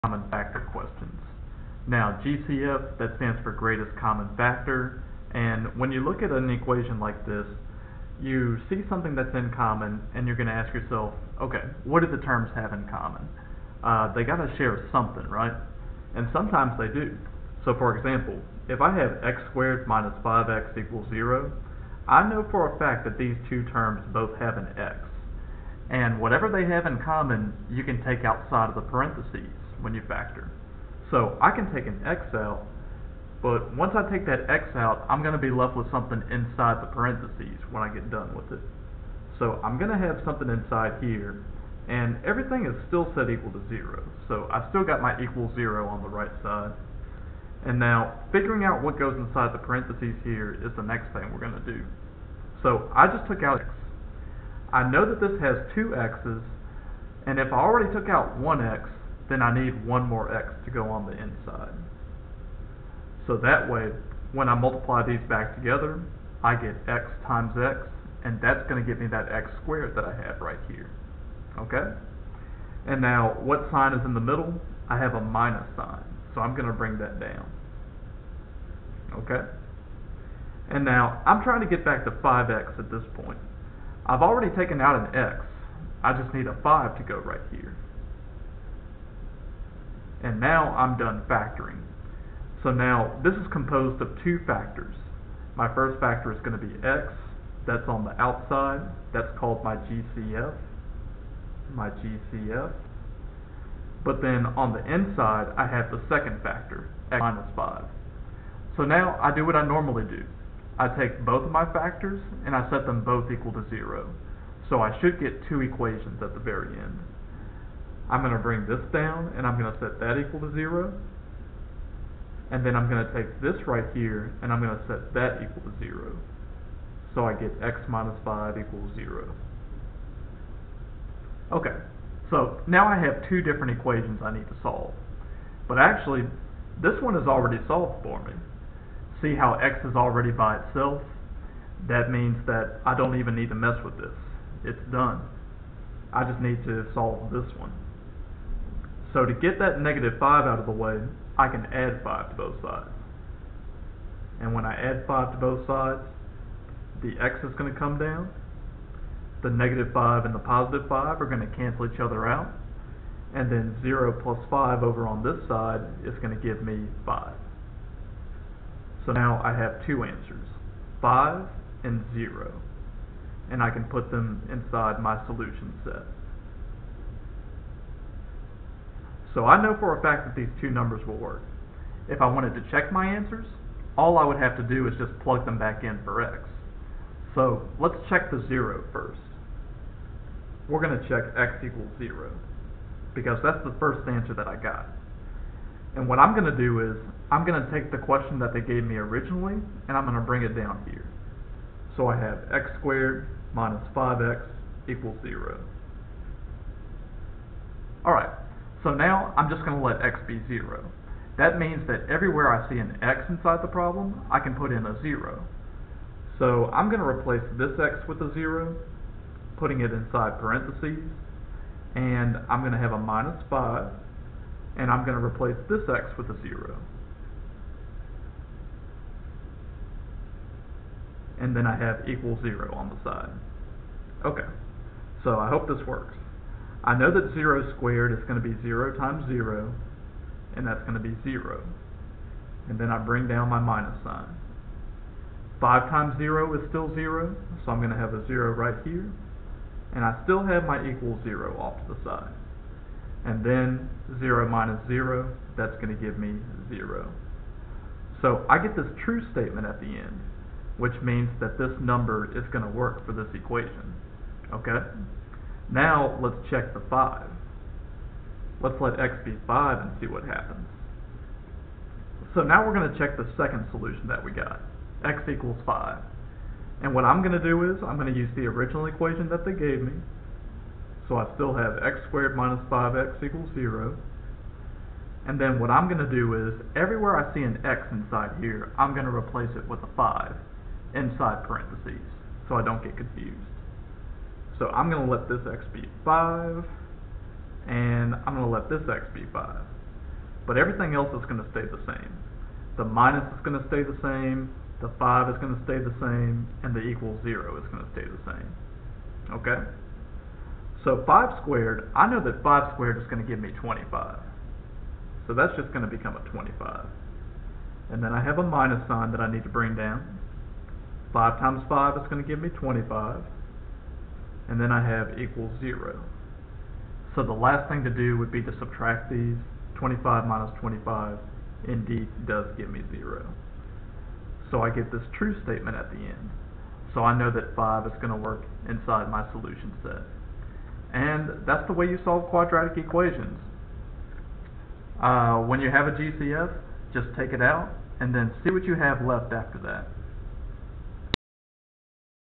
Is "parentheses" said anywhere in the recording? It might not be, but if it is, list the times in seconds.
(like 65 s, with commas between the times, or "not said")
28 s, 36 s, 49 s, 220 s, 291 s.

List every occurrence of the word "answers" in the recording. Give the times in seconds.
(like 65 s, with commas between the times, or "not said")
170 s, 183 s, 194 s.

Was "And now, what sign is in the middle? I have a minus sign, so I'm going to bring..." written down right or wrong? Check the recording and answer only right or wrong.
right.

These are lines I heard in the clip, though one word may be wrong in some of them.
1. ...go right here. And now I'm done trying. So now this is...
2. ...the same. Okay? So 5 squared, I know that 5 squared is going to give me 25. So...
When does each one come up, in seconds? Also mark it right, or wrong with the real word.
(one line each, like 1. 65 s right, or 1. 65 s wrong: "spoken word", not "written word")
1. 87 s wrong: "factoring", not "trying"
2. 308 s right.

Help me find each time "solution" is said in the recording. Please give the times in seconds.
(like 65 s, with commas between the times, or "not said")
175 s, 273 s, 339 s.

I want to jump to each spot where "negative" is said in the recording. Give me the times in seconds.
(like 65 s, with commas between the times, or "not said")
149 s, 159 s.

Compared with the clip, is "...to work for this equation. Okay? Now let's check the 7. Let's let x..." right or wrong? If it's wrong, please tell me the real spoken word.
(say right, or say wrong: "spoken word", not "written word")
wrong: "5", not "7".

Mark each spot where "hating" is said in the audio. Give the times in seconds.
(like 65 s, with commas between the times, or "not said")
not said.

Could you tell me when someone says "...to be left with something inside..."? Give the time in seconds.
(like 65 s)
35 s.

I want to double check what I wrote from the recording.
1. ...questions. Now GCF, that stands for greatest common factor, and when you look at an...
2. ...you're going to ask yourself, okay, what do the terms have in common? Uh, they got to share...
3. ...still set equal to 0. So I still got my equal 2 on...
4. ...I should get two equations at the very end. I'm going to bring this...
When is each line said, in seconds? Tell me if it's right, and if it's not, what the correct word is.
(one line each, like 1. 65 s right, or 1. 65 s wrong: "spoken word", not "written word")
1. 0 s right
2. 10 s right
3. 42 s wrong: "0", not "2"
4. 114 s right.